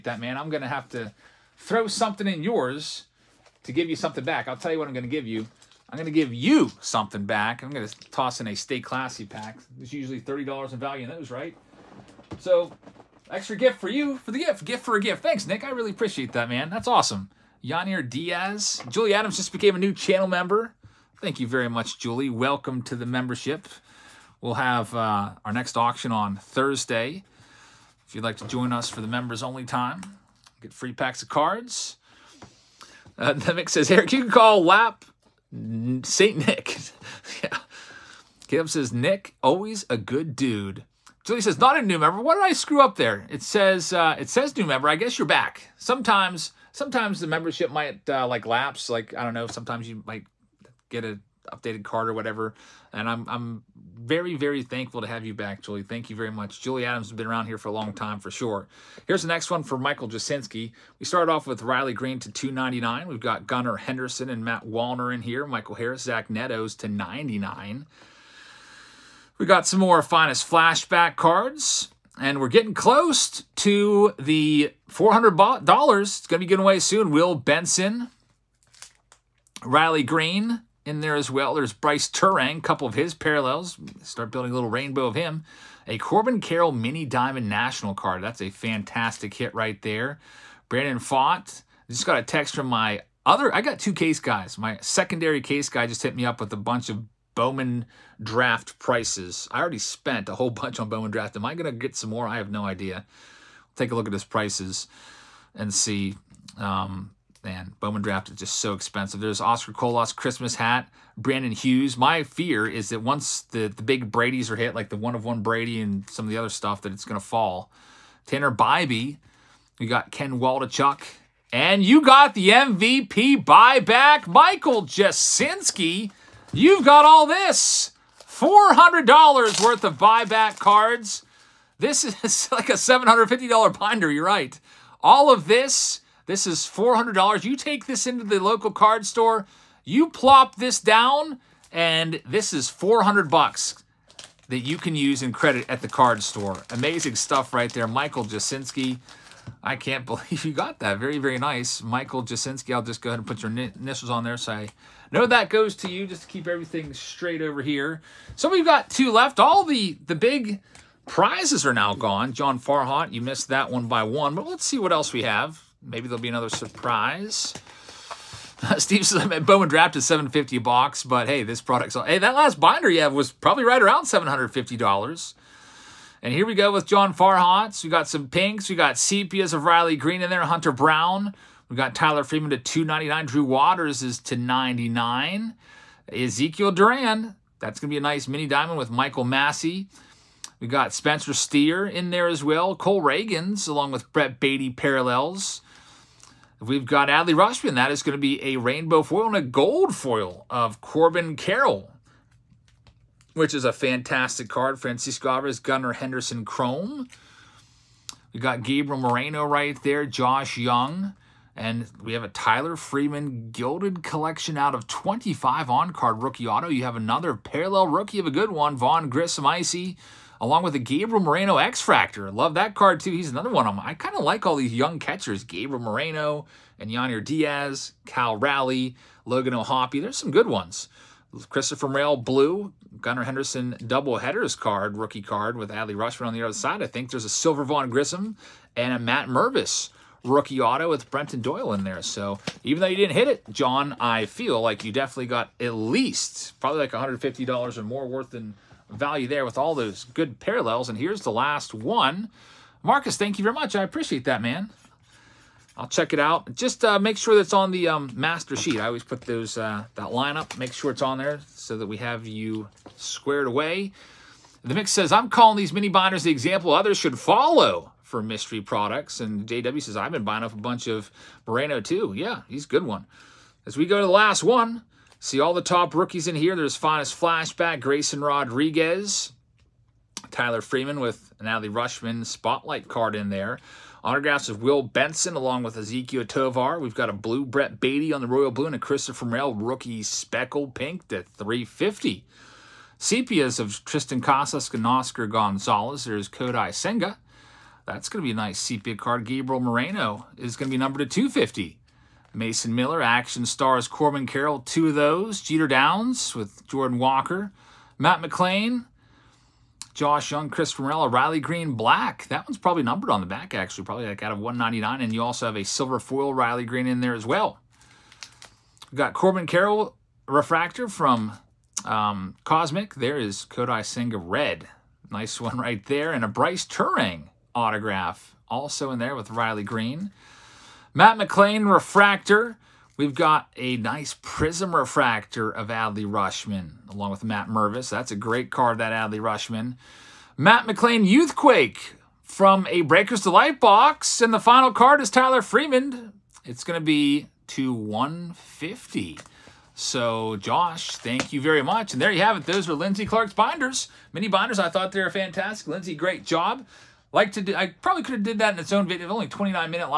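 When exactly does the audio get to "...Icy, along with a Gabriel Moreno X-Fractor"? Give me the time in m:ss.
3:39.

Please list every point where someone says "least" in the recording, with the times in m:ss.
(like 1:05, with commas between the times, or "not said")
4:05.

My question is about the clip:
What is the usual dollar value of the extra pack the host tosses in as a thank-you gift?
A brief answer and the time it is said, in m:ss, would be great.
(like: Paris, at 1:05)
$30, at 0:10.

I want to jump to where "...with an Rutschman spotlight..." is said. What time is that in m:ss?
4:41.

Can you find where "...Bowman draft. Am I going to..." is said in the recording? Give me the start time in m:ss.
1:40.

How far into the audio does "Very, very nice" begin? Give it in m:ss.
2:30.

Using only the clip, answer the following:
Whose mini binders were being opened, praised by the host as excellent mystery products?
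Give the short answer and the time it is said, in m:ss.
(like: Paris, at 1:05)
Lindsey Clark, at 5:52.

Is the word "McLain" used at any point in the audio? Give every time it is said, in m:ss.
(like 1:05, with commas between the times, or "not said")
5:08, 5:31, 5:40.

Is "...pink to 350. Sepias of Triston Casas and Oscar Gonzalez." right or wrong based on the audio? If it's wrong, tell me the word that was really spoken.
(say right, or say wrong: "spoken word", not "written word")
right.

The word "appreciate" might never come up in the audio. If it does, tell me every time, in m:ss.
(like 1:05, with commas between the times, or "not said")
0:15, 4:13.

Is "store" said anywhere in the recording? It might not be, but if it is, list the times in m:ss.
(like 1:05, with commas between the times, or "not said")
2:19, 2:26.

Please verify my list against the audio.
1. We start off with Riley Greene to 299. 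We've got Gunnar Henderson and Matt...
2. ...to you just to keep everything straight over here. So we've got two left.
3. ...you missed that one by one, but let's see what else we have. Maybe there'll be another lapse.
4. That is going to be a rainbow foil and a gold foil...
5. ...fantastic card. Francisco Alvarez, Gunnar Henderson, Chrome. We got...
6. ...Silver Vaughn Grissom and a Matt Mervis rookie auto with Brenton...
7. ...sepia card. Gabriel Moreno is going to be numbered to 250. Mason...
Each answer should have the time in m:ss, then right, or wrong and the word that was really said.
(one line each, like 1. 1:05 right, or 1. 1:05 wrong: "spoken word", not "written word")
1. 1:00 right
2. 2:35 right
3. 2:43 wrong: "surprise", not "lapse"
4. 3:17 right
5. 3:23 right
6. 3:57 right
7. 4:58 right.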